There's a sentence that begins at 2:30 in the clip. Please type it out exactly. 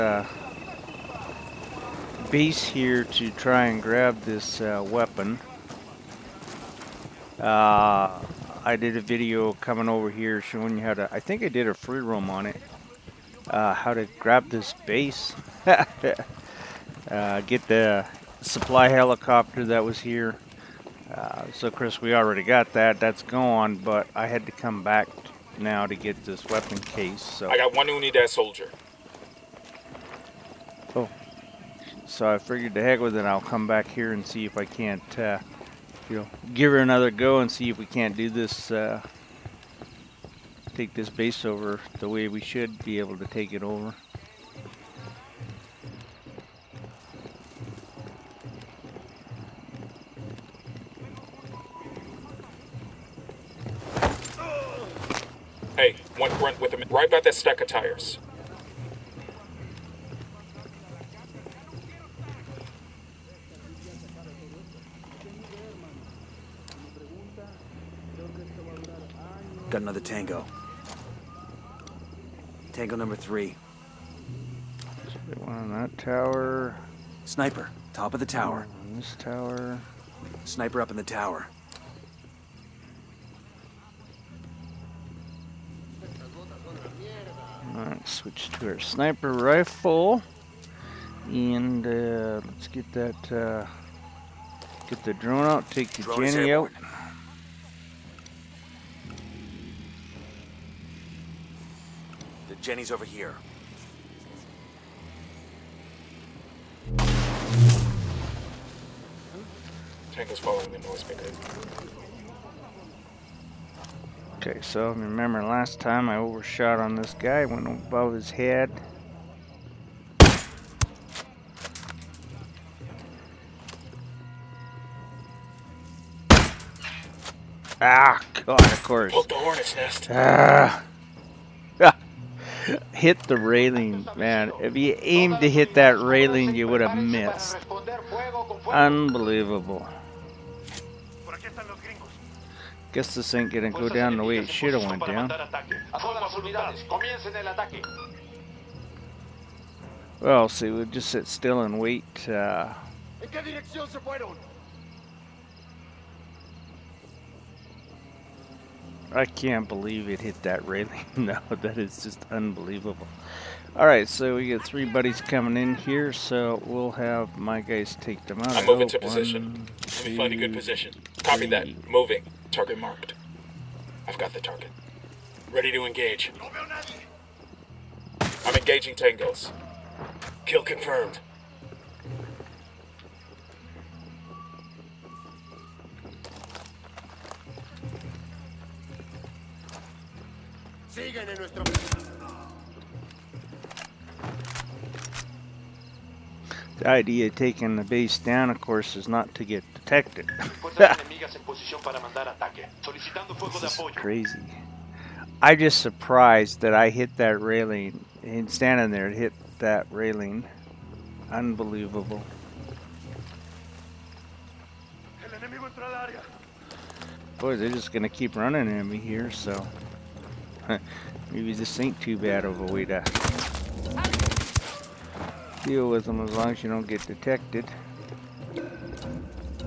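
Well, see, we'll just sit still and wait.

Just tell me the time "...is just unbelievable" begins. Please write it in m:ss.
2:41.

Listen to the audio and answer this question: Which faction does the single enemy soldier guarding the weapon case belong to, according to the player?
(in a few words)
Unidad.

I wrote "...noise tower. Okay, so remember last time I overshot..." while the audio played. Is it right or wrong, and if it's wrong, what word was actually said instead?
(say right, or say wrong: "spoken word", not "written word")
wrong: "maker", not "tower".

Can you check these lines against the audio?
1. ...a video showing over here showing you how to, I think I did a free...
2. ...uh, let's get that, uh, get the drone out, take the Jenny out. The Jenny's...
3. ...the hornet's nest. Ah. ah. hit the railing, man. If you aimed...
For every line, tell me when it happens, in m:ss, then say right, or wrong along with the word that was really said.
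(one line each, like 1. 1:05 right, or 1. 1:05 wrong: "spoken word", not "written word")
1. 0:08 wrong: "coming", not "showing"
2. 1:31 right
3. 2:09 right.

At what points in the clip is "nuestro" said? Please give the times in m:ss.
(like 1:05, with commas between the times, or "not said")
3:11.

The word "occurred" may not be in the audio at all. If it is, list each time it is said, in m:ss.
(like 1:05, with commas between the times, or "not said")
not said.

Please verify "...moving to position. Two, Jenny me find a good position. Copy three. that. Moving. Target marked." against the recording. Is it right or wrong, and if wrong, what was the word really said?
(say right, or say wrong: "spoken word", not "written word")
wrong: "Let", not "Jenny".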